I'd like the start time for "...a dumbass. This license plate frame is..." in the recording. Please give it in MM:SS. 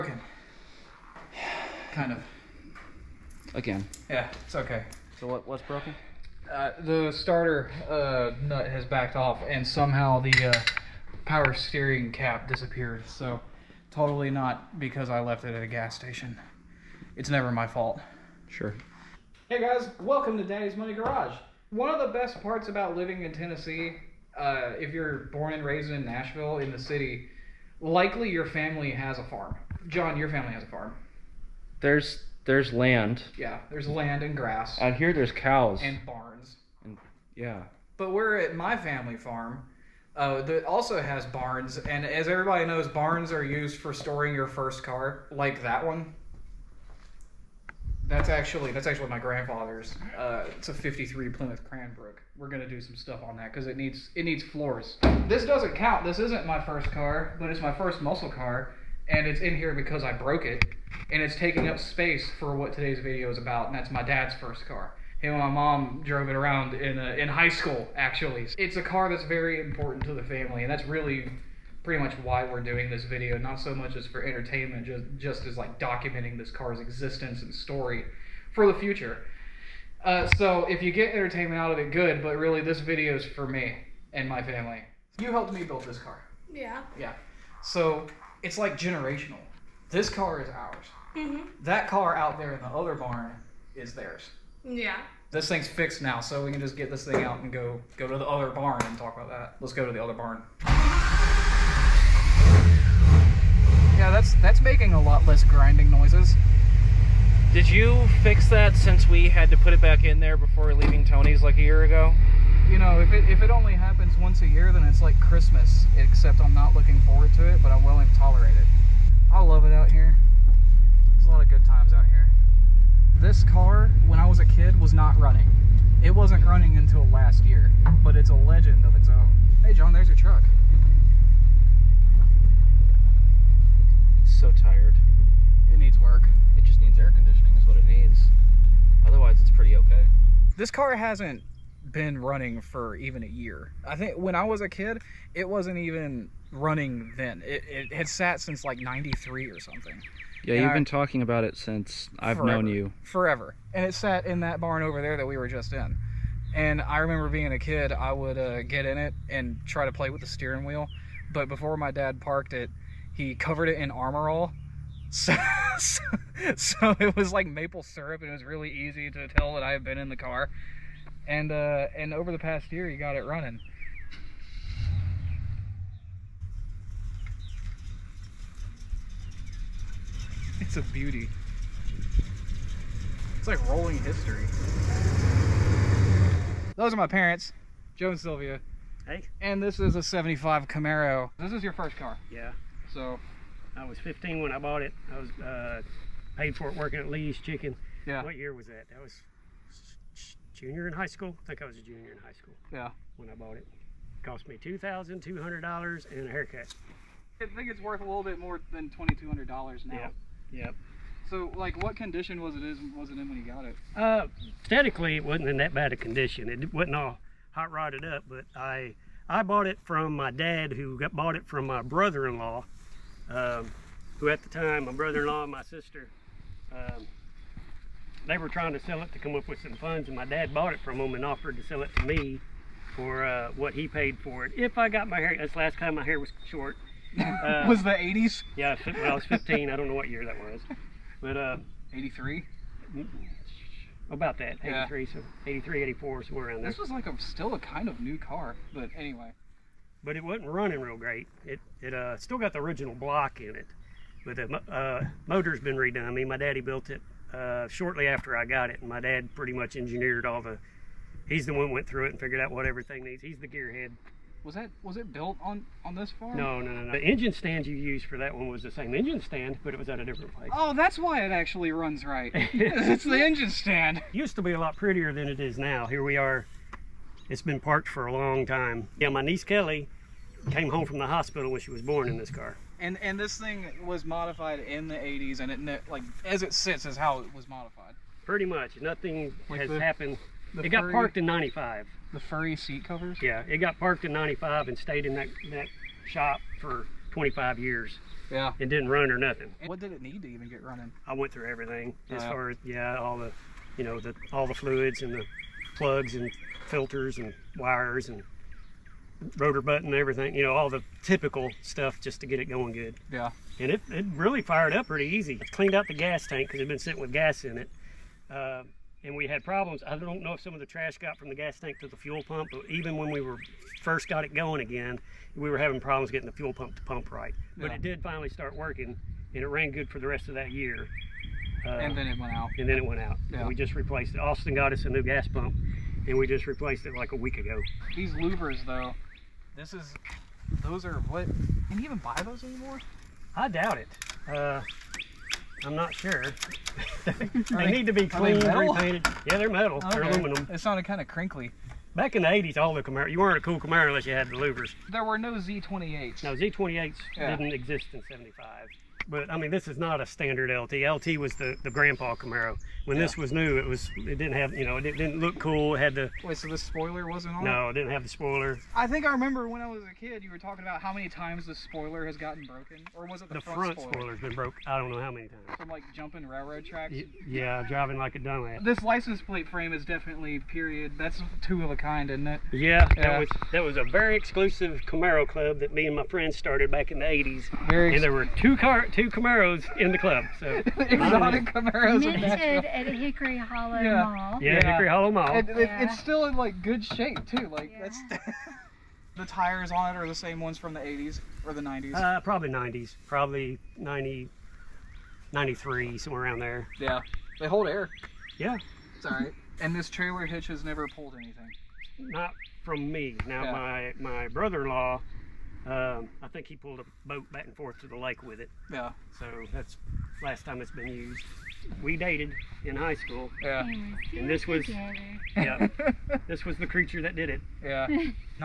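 06:18.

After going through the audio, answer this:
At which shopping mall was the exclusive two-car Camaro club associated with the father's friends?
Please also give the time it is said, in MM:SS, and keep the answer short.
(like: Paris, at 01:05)
Hickory Hollow Mall, at 06:34.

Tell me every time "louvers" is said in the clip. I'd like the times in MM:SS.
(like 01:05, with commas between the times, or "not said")
05:38, 05:54.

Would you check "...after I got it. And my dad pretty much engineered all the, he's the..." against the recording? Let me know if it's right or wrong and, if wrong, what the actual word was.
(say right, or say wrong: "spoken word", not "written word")
right.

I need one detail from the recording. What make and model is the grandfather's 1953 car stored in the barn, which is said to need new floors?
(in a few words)
Plymouth Cranbrook.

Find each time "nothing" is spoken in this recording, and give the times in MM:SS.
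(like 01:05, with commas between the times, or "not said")
04:48, 04:59.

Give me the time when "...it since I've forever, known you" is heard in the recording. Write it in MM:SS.
02:31.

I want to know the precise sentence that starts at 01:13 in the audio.
Not so much as for entertainment, just just as like documenting this car's existence and story for the future.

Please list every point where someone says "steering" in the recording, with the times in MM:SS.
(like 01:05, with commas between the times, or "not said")
00:11, 02:40.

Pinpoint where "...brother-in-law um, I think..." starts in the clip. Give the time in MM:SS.
06:54.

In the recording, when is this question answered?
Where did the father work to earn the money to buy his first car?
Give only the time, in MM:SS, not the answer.
03:17.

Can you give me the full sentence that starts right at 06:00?
LT was the, the grandpa Camaro.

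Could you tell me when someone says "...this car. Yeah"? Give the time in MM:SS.
01:25.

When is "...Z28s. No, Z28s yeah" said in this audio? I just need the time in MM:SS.
05:55.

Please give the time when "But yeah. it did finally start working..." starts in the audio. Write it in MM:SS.
05:27.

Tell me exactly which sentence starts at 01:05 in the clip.
Him and my mom drove it around in a, uh, in high school, actually.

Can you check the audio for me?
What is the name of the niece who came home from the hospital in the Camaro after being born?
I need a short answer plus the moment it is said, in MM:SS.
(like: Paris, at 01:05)
Kelly, at 04:39.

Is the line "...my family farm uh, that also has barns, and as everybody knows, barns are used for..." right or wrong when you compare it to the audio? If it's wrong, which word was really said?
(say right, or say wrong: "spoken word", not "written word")
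right.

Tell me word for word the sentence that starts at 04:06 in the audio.
This was like a still a kind of new car, but anyway.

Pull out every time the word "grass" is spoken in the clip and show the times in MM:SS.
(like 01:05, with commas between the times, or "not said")
00:34.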